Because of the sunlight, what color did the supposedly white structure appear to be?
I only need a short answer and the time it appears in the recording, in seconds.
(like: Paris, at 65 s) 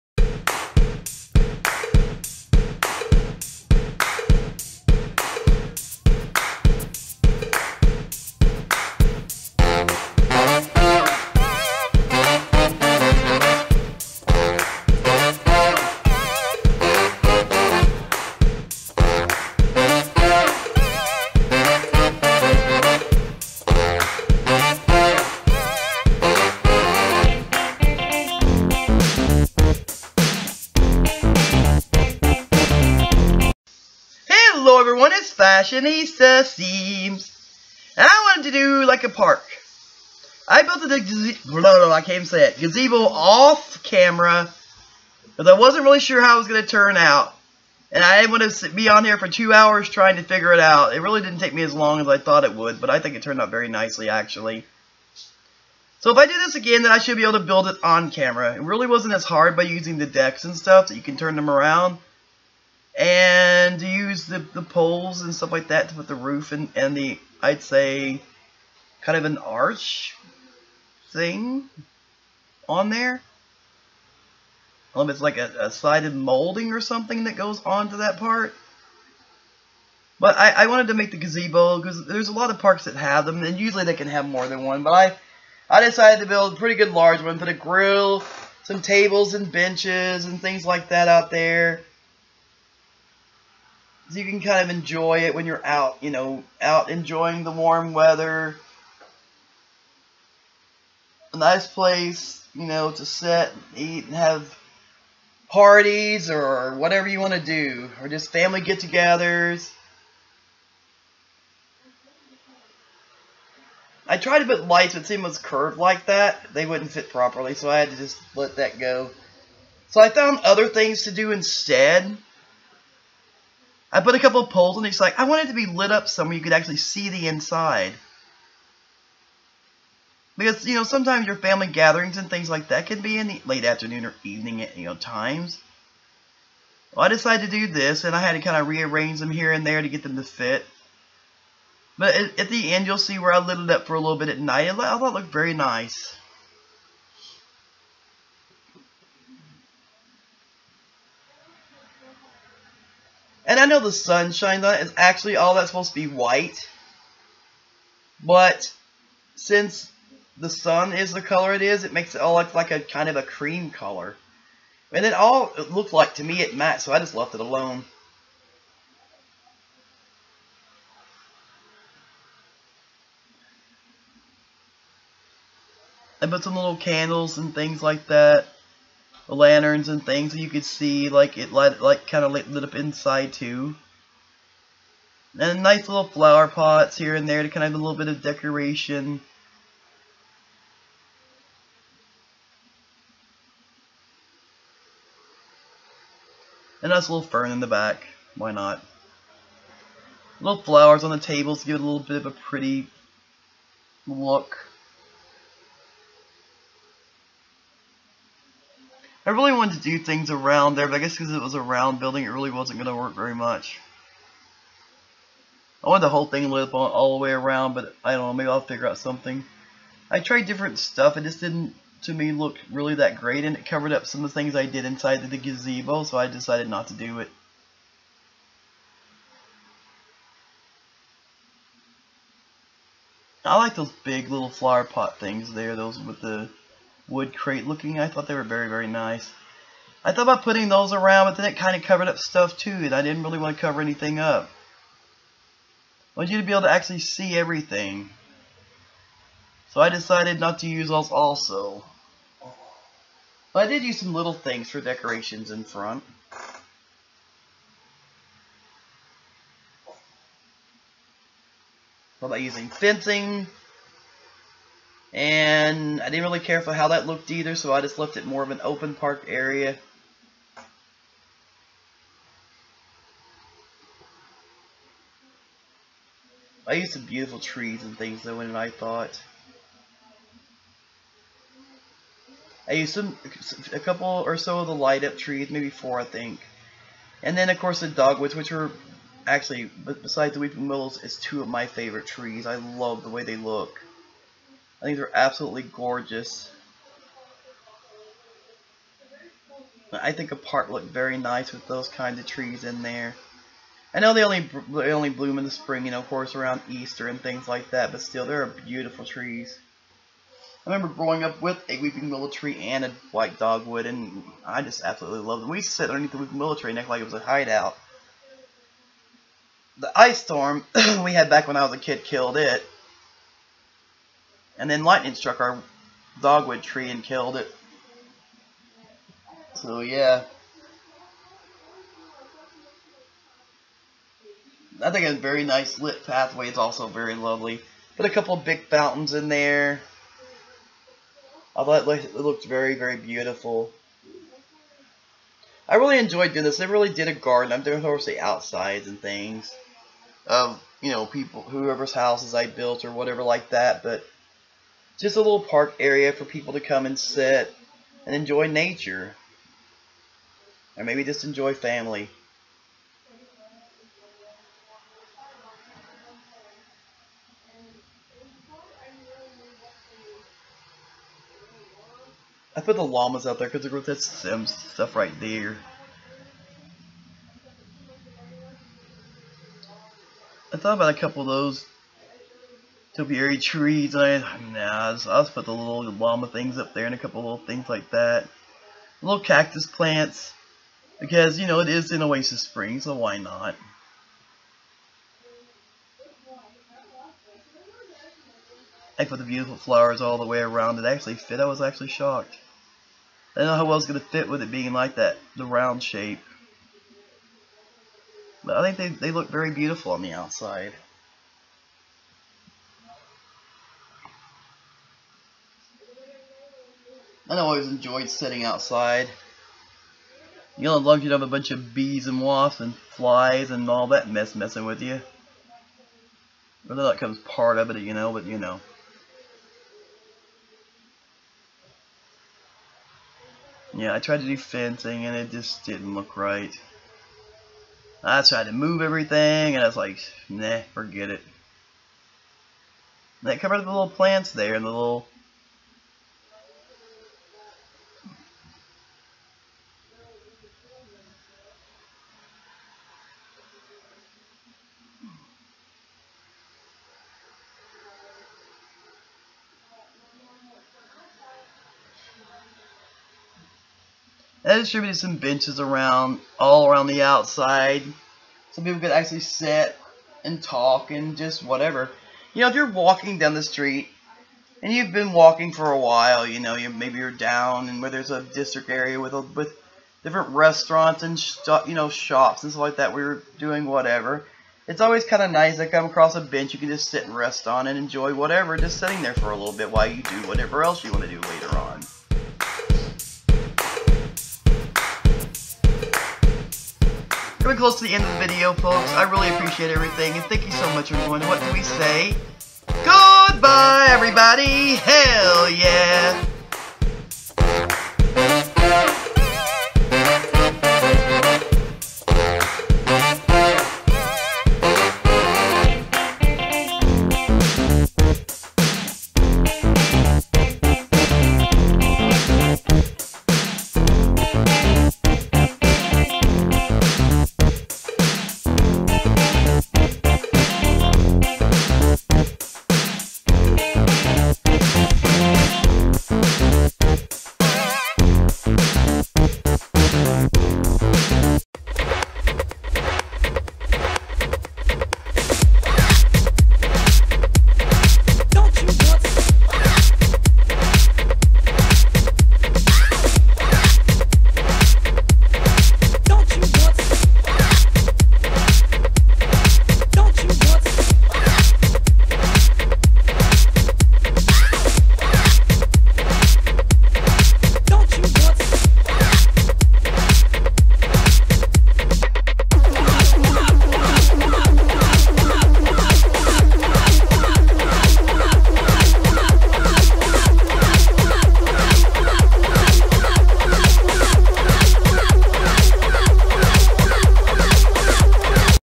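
Cream, at 163 s.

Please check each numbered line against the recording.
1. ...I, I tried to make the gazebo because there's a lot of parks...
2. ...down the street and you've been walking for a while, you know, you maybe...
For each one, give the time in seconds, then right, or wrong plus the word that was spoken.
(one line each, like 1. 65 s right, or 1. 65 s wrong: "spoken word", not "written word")
1. 80 s wrong: "wanted", not "tried"
2. 473 s right.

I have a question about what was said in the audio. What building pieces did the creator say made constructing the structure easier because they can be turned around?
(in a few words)
Decks.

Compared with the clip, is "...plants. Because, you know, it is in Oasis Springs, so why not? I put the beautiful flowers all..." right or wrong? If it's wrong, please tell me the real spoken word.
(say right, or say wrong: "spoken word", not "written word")
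right.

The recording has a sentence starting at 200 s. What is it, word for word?
Little flowers on the tables give it a little bit of a pretty look.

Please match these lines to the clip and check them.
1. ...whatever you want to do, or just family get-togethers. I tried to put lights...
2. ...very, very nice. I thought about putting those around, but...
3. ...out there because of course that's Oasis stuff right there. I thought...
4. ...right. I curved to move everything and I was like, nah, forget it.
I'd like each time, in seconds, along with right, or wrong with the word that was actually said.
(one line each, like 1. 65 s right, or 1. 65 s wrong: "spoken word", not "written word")
1. 106 s right
2. 238 s right
3. 373 s wrong: "Sims", not "Oasis"
4. 436 s wrong: "tried", not "curved".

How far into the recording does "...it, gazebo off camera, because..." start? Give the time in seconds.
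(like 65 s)
42 s.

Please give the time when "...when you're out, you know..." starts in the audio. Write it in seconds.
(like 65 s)
95 s.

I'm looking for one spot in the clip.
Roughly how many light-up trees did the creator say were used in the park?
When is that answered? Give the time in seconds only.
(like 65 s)
285 s.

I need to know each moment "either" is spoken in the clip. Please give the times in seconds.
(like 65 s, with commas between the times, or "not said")
267 s.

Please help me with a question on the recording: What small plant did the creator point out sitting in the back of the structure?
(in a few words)
Fern.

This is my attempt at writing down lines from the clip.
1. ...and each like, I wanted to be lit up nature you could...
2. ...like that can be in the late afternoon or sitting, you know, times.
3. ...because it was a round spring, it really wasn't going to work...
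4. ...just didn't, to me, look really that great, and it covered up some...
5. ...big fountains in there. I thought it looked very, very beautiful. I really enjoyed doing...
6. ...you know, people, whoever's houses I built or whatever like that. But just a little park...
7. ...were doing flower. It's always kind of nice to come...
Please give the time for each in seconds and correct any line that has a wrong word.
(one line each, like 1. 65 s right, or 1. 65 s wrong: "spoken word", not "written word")
1. 124 s wrong: "somewhere", not "nature"
2. 132 s wrong: "evening", not "sitting"
3. 211 s wrong: "building", not "spring"
4. 221 s right
5. 338 s right
6. 350 s right
7. 483 s wrong: "whatever", not "flower".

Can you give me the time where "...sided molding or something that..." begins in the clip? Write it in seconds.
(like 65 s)
75 s.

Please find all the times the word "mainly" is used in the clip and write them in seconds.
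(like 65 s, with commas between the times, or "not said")
not said.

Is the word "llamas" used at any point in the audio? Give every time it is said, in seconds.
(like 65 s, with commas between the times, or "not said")
372 s, 385 s.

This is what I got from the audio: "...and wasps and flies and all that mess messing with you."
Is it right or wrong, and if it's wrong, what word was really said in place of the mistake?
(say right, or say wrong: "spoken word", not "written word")
right.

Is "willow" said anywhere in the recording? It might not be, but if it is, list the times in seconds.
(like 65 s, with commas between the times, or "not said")
290 s, 312 s, 316 s.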